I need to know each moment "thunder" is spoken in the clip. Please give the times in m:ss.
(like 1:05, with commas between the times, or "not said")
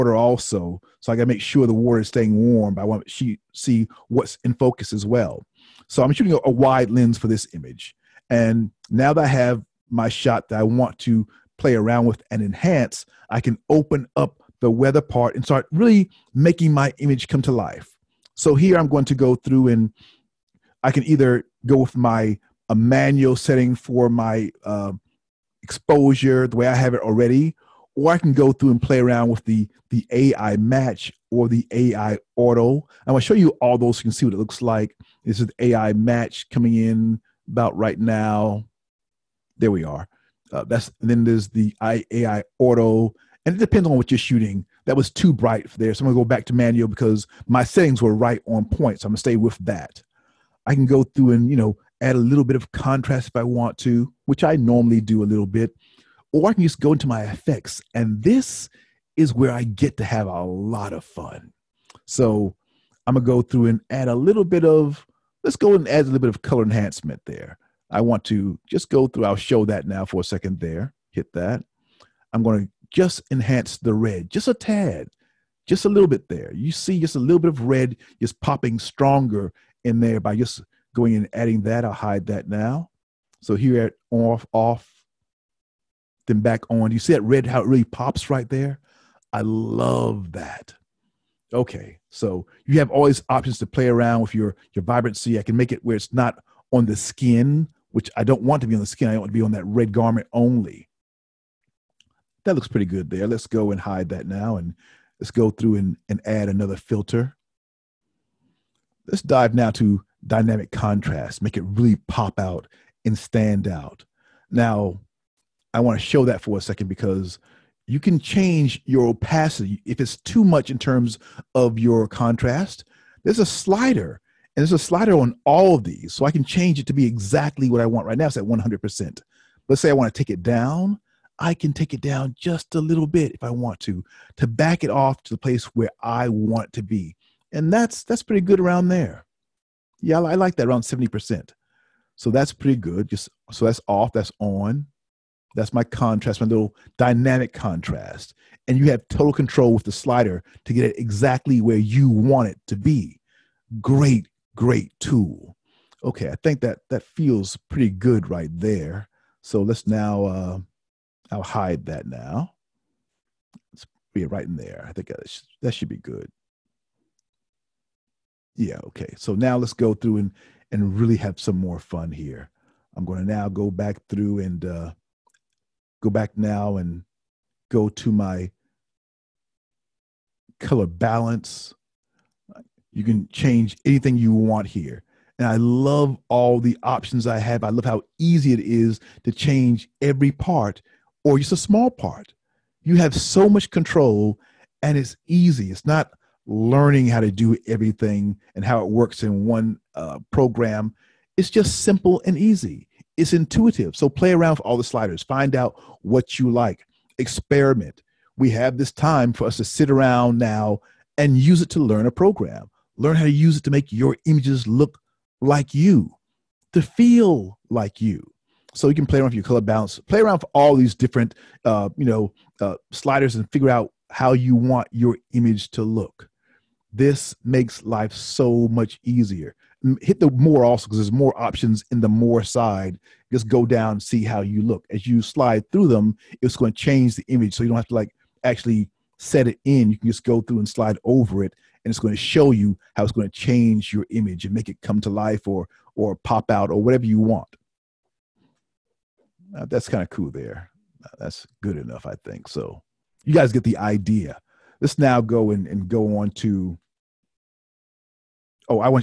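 not said.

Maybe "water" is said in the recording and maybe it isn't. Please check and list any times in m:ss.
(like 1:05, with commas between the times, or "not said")
0:01.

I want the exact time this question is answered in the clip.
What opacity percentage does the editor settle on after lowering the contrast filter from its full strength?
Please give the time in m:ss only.
2:20.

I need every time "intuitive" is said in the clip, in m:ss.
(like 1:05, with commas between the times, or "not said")
3:23.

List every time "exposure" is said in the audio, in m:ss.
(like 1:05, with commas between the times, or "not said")
0:25.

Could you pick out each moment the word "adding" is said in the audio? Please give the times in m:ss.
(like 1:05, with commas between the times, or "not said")
1:21.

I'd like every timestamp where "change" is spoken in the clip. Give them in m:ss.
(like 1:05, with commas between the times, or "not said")
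1:58, 2:06, 3:03, 3:09, 3:56, 4:03.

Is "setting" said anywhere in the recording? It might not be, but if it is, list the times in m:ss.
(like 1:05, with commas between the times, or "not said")
0:23, 0:47.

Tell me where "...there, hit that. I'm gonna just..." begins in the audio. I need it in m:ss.
1:10.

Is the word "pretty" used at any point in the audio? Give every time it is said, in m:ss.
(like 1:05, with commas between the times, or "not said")
1:42, 2:18, 2:22, 2:37.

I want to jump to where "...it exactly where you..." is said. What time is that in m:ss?
2:30.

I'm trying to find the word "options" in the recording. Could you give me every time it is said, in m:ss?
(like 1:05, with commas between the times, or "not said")
1:33, 3:06, 3:51.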